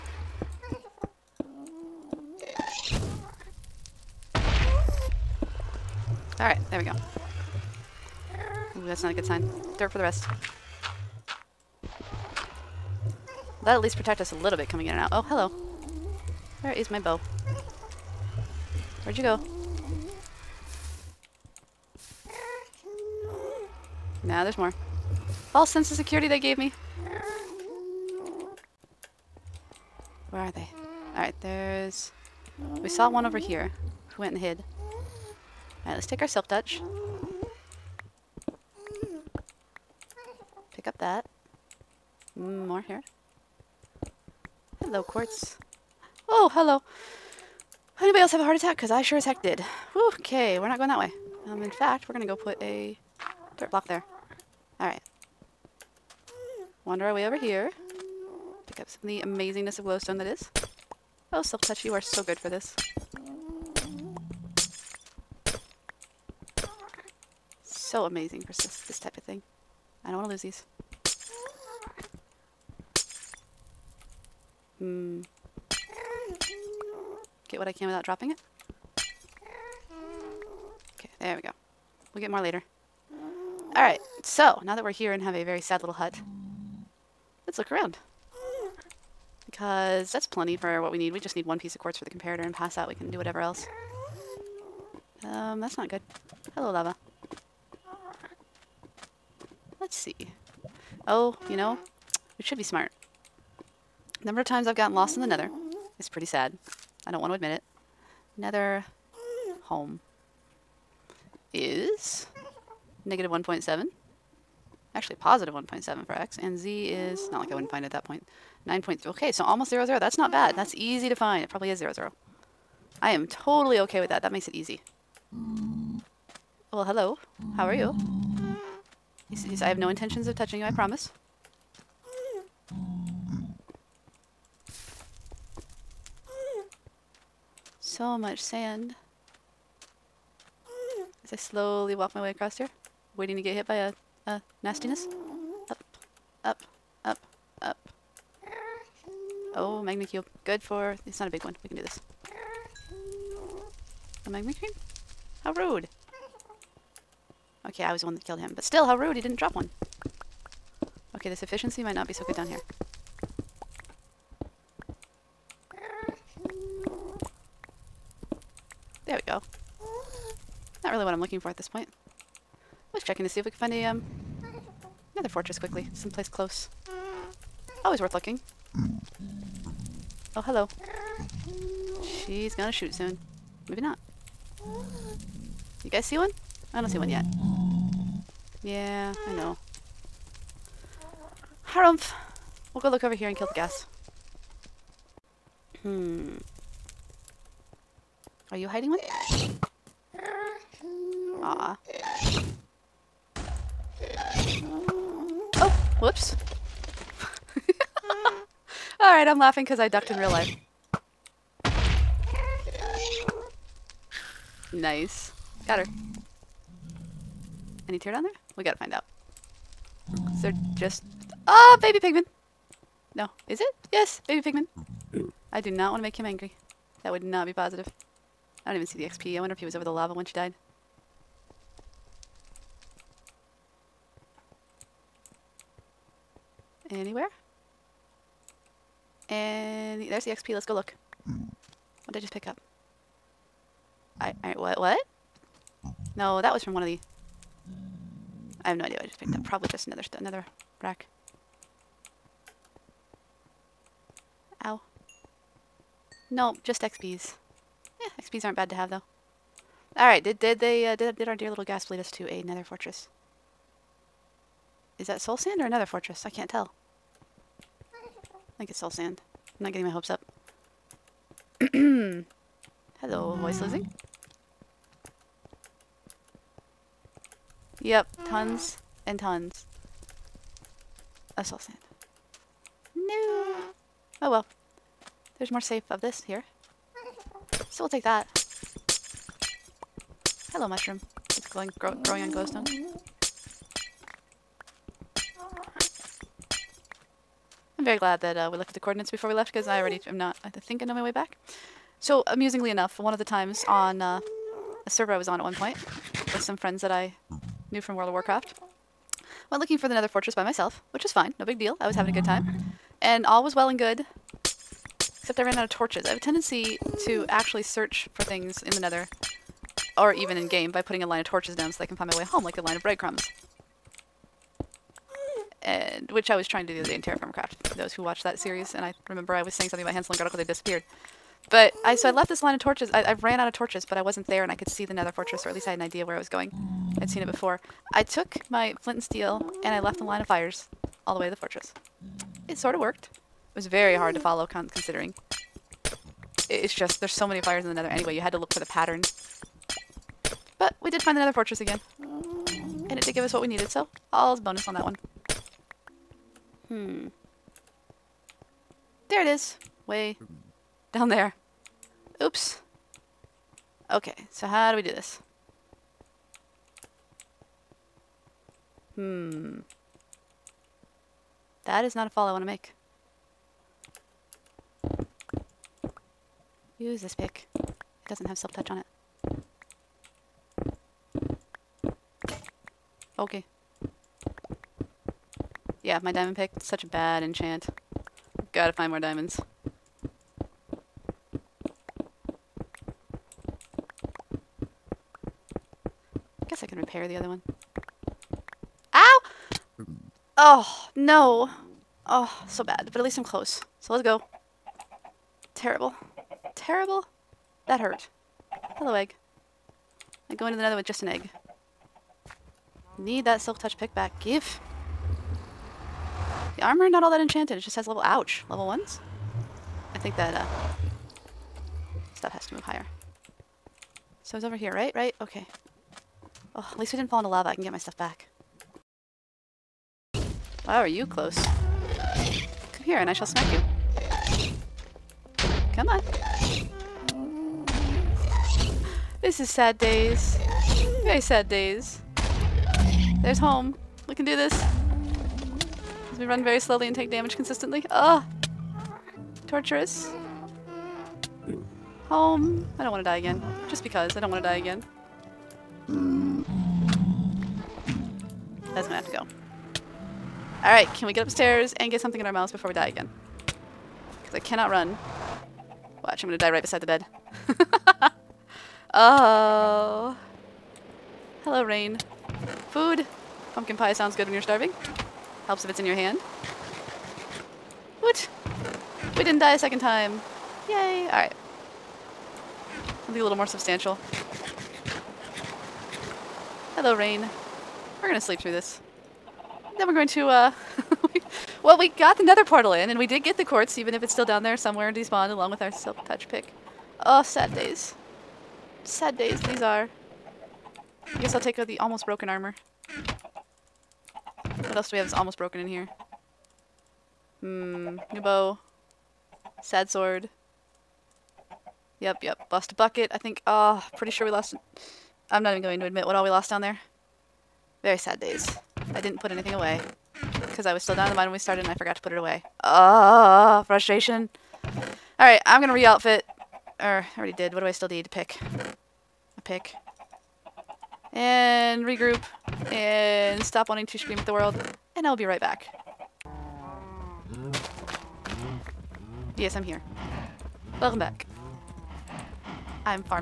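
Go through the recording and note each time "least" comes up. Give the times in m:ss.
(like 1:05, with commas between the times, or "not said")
0:13, 5:35, 6:43, 7:06.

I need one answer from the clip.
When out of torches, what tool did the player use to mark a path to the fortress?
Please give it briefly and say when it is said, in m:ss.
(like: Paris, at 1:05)
flint and steel, at 5:38.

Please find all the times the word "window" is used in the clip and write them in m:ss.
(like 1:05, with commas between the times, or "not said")
not said.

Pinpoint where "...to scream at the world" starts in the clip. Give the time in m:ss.
8:53.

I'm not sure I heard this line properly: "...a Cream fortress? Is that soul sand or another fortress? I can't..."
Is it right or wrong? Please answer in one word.
wrong.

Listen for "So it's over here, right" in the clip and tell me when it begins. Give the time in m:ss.
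7:04.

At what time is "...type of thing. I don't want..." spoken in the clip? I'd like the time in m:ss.
1:08.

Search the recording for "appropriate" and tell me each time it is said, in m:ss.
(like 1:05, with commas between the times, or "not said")
not said.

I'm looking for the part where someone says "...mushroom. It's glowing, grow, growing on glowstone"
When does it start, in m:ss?
4:50.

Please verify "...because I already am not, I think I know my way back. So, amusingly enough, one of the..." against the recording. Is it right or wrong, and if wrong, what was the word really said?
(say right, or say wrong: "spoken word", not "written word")
right.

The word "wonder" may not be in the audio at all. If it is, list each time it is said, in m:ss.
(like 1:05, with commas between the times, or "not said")
3:49.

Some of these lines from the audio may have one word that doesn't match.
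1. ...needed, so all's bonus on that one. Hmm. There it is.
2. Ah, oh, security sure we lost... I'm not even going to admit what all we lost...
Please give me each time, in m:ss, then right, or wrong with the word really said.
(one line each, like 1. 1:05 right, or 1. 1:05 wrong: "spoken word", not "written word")
1. 5:53 right
2. 8:33 wrong: "pretty", not "security".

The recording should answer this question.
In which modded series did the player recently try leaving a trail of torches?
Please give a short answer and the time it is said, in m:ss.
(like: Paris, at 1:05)
TerraFirmaCraft, at 5:27.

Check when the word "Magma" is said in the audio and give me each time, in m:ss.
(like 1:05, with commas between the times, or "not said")
2:29, 2:34.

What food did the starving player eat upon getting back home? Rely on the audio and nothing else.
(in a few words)
Pumpkin pie.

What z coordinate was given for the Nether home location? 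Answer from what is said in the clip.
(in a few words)
9.3.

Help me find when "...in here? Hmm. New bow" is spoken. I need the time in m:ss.
8:25.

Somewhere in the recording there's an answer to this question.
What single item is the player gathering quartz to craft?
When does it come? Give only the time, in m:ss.
1:32.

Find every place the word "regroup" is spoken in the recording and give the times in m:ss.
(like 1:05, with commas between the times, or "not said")
8:51.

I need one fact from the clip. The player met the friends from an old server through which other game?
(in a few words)
World of Warcraft.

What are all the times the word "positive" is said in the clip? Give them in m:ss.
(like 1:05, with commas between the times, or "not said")
1:55, 3:47.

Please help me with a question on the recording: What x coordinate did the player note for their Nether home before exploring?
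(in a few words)
1.7.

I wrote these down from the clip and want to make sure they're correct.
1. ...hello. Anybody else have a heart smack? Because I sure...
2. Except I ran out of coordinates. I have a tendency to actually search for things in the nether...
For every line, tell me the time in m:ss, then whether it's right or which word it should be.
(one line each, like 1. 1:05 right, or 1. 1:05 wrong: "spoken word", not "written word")
1. 0:46 wrong: "attack", not "smack"
2. 5:14 wrong: "torches", not "coordinates".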